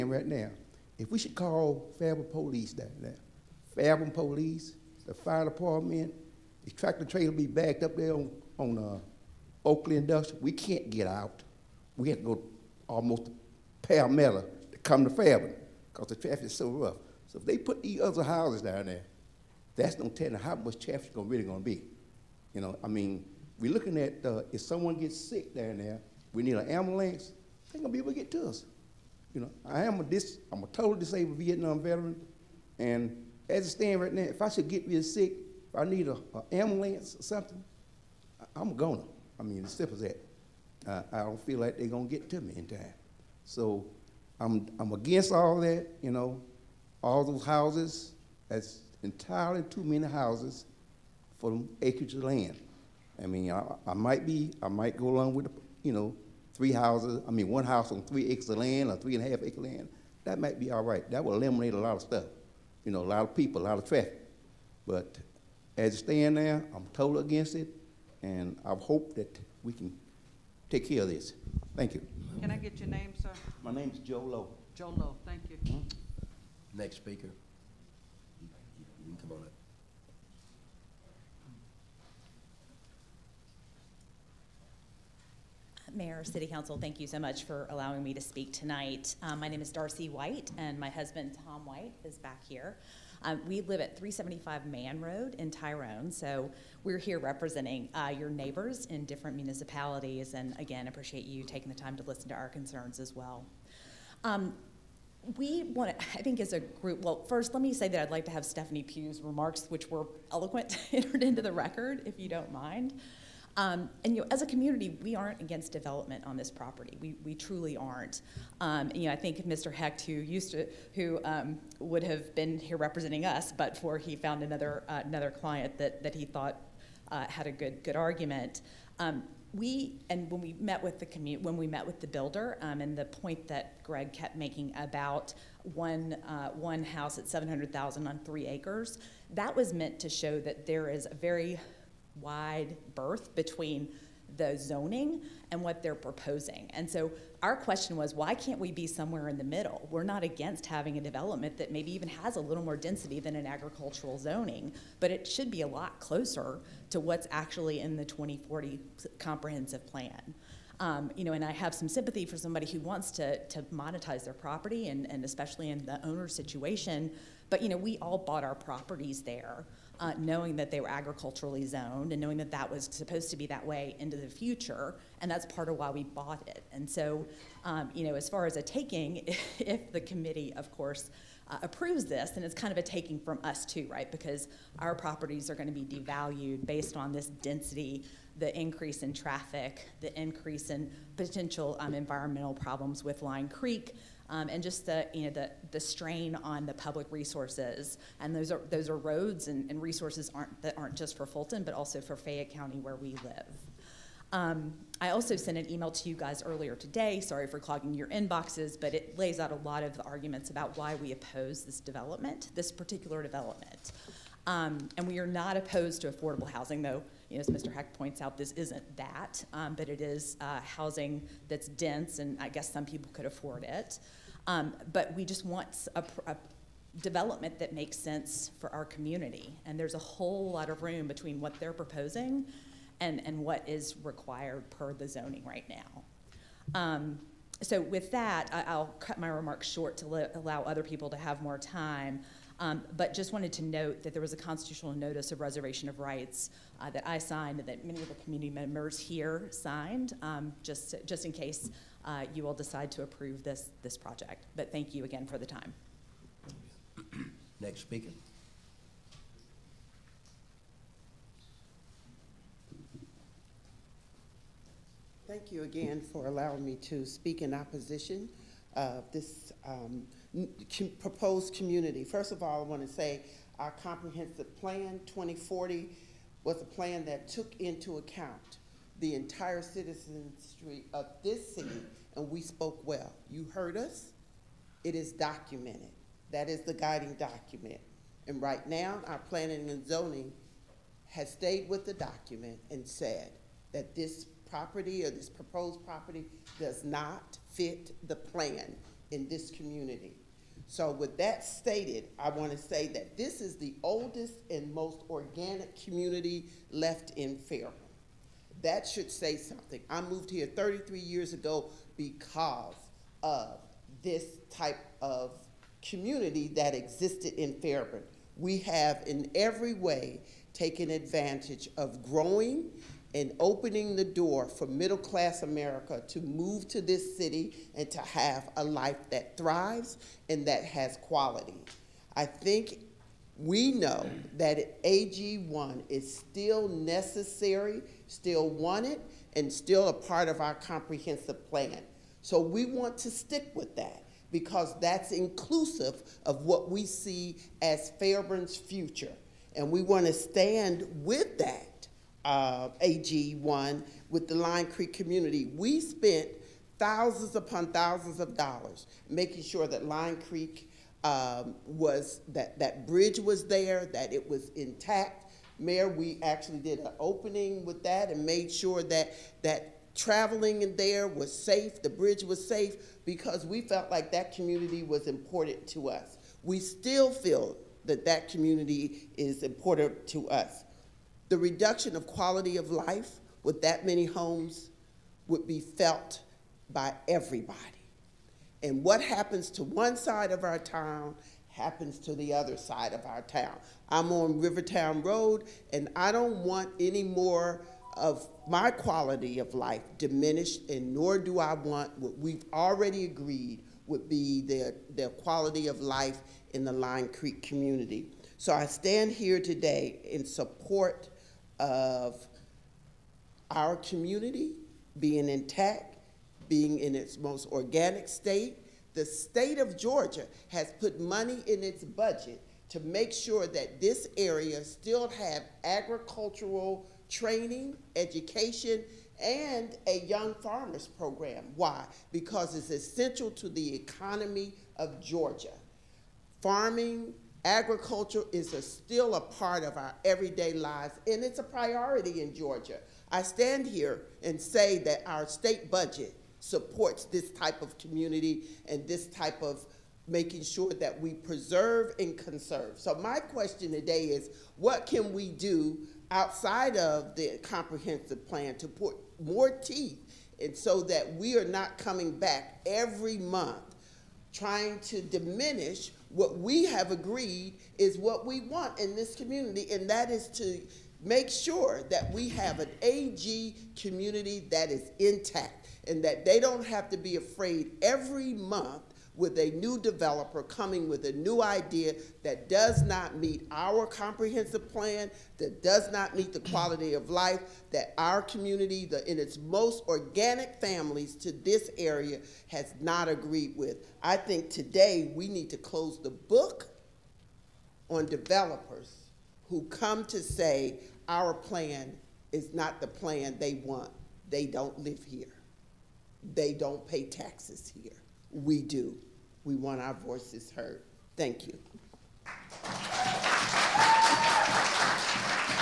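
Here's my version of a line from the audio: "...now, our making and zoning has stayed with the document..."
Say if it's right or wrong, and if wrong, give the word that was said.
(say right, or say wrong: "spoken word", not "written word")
wrong: "planning", not "making".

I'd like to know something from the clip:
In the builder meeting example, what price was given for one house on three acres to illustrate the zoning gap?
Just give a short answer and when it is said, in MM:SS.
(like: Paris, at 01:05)
$700,000, at 02:17.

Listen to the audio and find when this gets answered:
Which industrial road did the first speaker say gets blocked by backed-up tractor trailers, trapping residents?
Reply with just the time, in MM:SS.
00:09.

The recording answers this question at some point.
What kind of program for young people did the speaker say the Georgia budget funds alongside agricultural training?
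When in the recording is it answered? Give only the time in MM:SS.
07:10.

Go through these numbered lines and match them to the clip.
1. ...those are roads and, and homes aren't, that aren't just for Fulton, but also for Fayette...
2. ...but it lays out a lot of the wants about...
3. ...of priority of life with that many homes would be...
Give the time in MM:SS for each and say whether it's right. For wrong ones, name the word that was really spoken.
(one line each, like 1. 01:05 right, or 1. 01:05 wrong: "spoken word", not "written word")
1. 03:18 wrong: "resources", not "homes"
2. 03:28 wrong: "arguments", not "wants"
3. 06:21 wrong: "quality", not "priority".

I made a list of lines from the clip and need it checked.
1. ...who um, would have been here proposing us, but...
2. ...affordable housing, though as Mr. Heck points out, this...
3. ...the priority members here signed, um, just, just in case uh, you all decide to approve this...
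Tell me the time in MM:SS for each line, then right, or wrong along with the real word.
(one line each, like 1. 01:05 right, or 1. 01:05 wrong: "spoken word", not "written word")
1. 02:00 wrong: "representing", not "proposing"
2. 03:36 right
3. 04:08 wrong: "community", not "priority".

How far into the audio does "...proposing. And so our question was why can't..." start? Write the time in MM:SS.
02:25.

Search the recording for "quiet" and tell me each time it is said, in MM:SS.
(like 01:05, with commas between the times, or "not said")
not said.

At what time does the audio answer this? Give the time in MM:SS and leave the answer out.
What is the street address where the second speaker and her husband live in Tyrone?
01:33.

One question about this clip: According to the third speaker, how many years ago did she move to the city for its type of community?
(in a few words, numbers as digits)
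33.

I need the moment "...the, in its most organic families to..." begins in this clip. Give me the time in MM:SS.
08:08.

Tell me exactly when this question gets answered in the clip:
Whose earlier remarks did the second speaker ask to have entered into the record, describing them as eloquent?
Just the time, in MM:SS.
01:48.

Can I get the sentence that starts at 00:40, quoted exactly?
Uh, I don't feel like they're gonna get to me in time.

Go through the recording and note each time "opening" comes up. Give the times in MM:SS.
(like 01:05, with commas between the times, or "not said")
05:23, 06:06.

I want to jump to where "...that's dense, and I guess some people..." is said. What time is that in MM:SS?
03:41.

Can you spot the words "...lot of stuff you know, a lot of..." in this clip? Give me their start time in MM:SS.
01:01.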